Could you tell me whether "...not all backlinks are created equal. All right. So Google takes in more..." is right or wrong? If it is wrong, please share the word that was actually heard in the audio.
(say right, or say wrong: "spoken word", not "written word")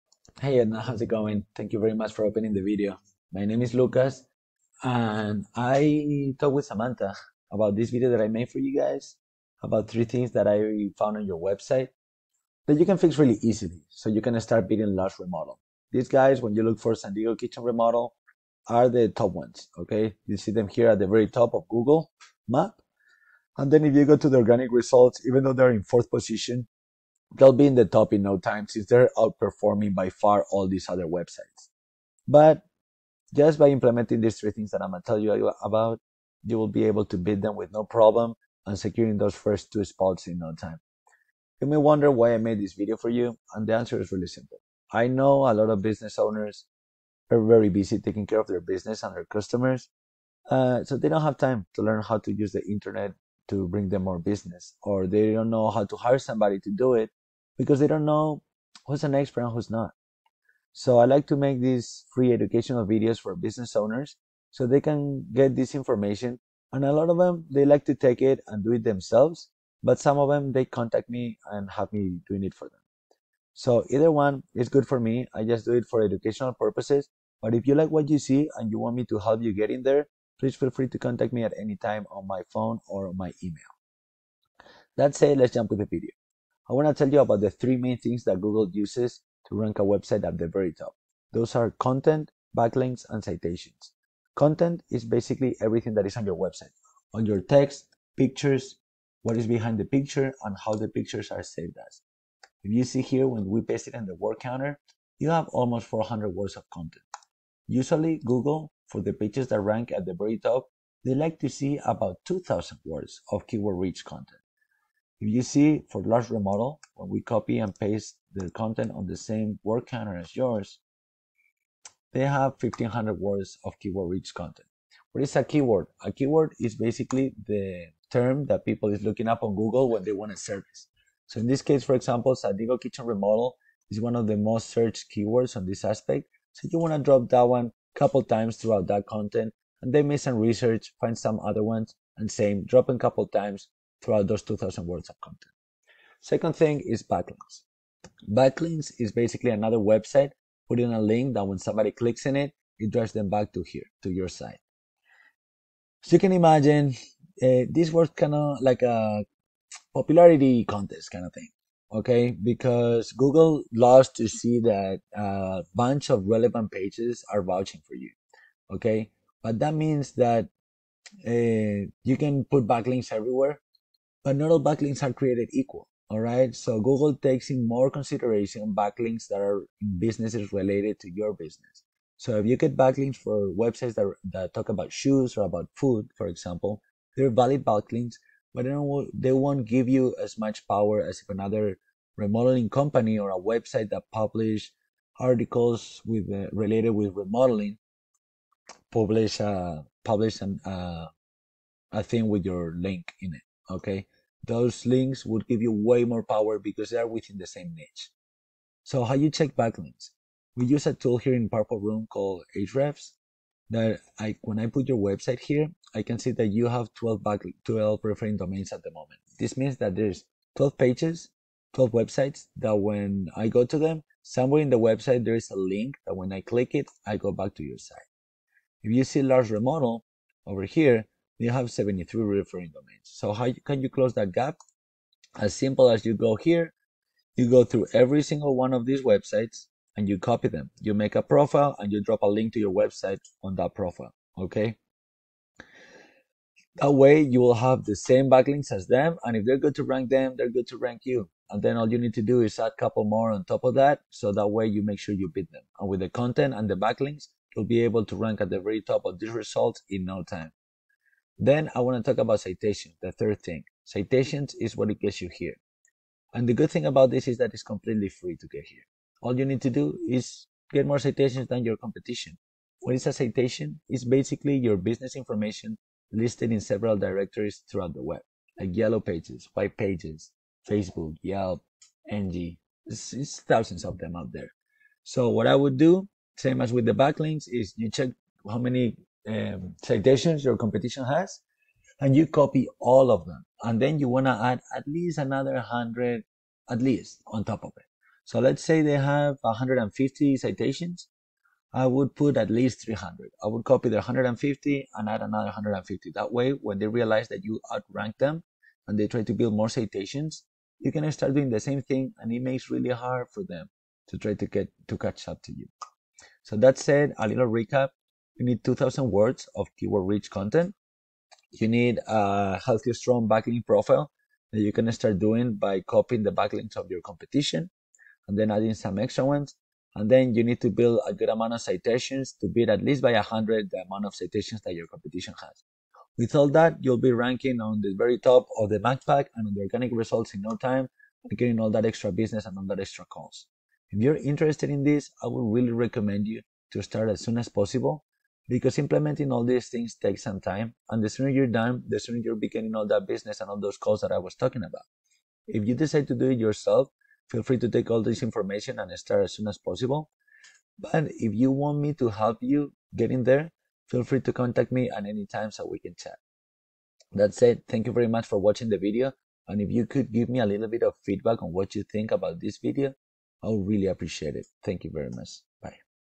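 right.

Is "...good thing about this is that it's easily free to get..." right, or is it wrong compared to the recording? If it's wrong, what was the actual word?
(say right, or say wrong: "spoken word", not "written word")
wrong: "completely", not "easily".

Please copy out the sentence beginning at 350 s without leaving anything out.
And the sooner you're done, the sooner you're beginning all that business and all those calls that I was talking about.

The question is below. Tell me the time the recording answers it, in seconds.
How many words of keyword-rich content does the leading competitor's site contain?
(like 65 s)
122 s.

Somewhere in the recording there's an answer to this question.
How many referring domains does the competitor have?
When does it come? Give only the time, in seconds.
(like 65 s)
231 s.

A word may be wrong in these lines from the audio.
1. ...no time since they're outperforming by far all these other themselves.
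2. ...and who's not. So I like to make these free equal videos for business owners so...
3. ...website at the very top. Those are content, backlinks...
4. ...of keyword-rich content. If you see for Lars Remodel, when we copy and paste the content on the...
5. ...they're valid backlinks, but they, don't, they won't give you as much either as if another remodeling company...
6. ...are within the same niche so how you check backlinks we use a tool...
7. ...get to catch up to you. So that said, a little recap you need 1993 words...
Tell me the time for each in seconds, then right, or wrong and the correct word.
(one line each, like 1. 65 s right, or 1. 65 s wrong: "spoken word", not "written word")
1. 28 s wrong: "websites", not "themselves"
2. 59 s wrong: "educational", not "equal"
3. 89 s right
4. 113 s right
5. 187 s wrong: "power", not "either"
6. 206 s right
7. 314 s wrong: "2000", not "1993".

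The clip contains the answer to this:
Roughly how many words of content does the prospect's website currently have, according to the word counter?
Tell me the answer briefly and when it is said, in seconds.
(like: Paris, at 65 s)
400, at 105 s.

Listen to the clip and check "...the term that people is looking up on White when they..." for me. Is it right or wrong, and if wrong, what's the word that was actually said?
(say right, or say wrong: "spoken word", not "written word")
wrong: "Google", not "White".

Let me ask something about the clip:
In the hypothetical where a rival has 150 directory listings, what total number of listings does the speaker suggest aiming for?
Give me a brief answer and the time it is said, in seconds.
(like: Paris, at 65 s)
300, at 302 s.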